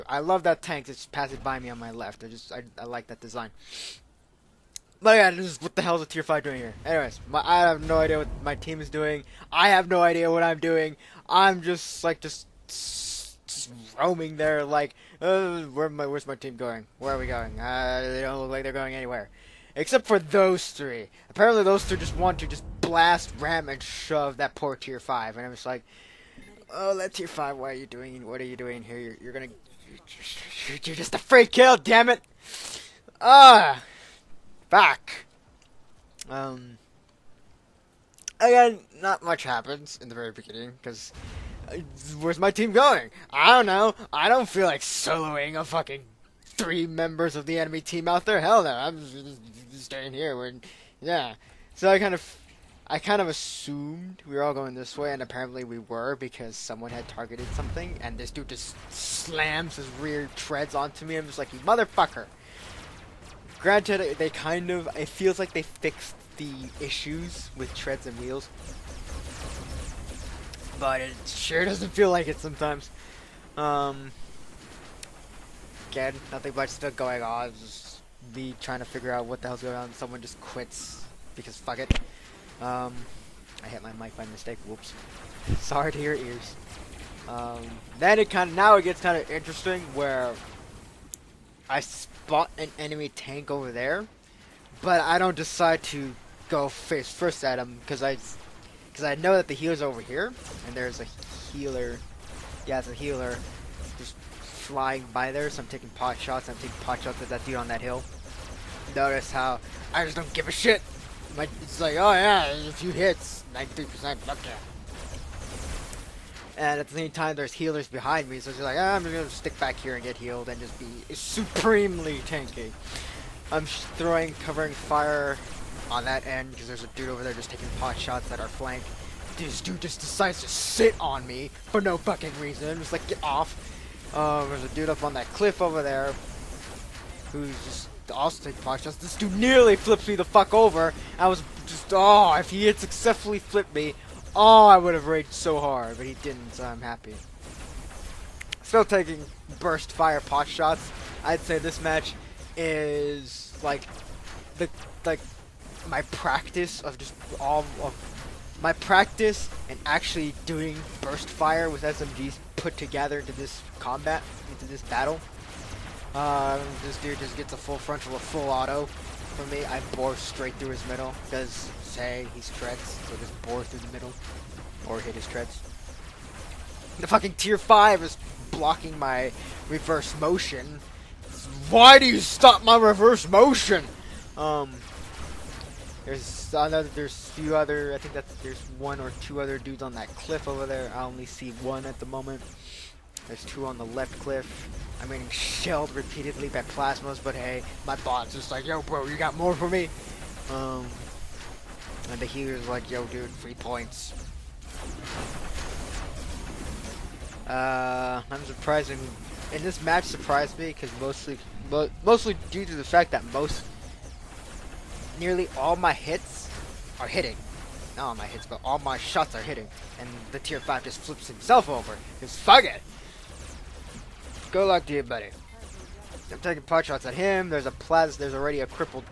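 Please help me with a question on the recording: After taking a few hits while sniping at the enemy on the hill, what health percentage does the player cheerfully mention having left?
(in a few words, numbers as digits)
93%.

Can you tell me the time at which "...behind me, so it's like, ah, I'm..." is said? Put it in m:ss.
1:57.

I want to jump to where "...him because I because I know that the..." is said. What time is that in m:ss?
1:37.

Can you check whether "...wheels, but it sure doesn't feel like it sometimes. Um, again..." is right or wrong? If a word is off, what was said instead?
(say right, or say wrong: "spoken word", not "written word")
right.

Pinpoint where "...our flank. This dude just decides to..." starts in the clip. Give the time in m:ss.
2:08.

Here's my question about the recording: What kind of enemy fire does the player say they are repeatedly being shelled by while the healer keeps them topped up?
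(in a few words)
plasmas.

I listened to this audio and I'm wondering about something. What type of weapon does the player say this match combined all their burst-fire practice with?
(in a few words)
SMGs.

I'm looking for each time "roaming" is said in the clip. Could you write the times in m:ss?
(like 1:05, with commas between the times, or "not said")
0:13.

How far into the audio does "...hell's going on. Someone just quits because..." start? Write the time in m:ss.
1:19.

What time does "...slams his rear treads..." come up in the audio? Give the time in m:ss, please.
0:58.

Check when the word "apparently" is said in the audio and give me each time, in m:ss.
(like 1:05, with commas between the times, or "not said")
0:21, 0:55.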